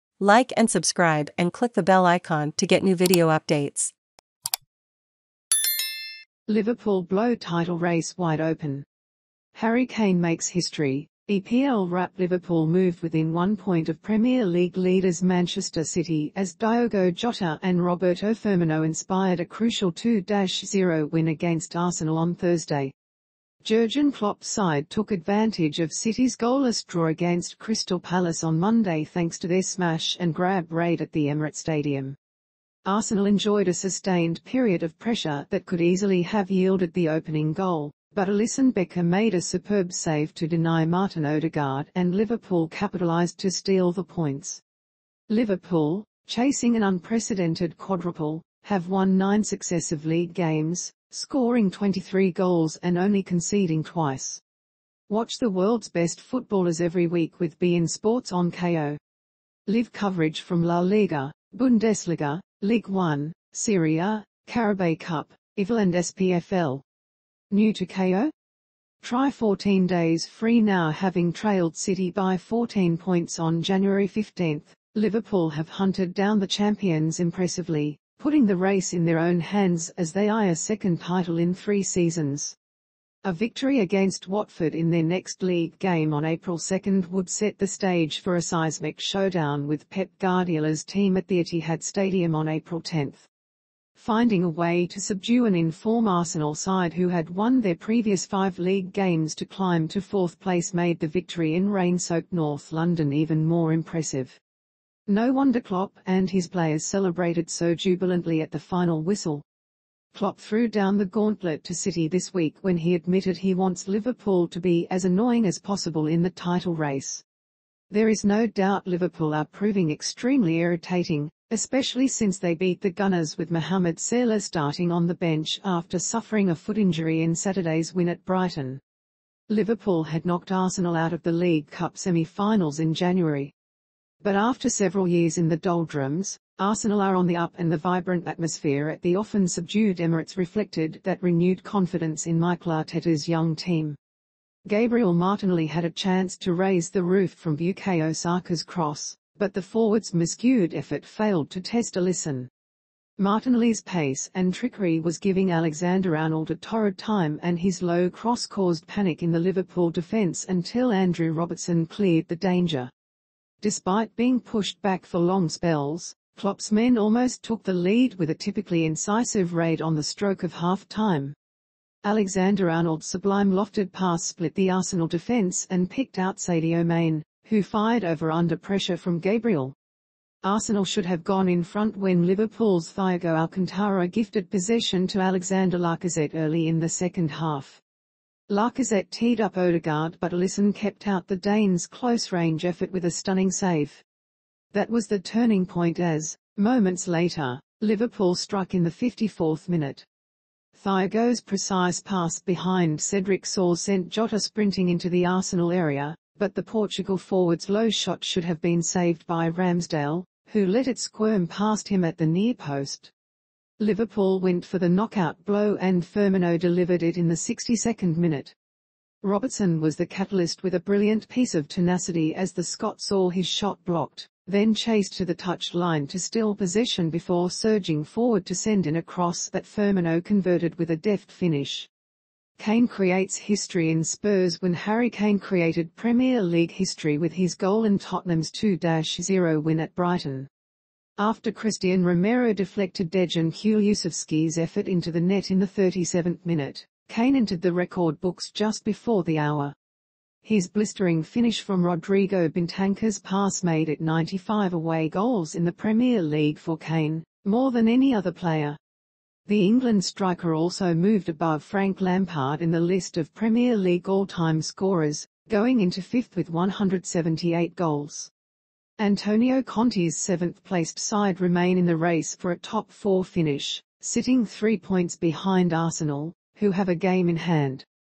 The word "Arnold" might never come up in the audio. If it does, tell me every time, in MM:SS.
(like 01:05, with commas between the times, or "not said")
02:36, 02:52.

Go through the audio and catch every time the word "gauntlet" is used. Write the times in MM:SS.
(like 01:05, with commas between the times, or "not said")
01:51.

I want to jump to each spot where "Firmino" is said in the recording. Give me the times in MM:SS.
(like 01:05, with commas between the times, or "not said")
00:18, 03:36, 03:49.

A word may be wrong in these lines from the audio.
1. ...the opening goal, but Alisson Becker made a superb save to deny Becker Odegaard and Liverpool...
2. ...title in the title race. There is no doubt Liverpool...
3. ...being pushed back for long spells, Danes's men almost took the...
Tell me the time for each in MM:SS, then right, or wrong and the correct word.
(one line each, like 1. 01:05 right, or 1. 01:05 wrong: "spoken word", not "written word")
1. 00:36 wrong: "Martin", not "Becker"
2. 01:55 wrong: "possible", not "title"
3. 02:44 wrong: "Klopp", not "Danes".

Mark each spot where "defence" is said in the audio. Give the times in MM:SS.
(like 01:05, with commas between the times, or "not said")
02:39, 02:55.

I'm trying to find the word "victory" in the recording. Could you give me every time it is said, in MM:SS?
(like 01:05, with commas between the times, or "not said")
01:23, 01:41.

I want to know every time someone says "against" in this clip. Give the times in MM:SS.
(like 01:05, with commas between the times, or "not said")
00:21, 00:27, 01:23.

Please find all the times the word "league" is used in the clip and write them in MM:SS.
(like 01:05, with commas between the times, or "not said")
00:14, 00:50, 01:25, 01:38, 02:11, 03:56, 04:16, 04:23.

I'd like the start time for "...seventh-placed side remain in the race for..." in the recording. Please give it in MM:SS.
04:30.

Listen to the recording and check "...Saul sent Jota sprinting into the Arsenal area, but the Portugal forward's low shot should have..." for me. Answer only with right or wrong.
right.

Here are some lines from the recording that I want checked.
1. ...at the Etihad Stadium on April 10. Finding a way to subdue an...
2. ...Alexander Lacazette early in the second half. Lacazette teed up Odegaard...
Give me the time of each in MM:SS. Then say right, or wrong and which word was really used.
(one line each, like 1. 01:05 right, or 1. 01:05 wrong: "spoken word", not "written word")
1. 01:31 right
2. 03:05 right.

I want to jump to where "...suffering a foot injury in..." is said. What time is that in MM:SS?
02:05.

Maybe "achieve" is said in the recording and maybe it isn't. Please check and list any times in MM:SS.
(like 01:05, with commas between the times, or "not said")
not said.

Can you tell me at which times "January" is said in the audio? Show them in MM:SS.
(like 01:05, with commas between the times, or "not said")
01:13, 02:12.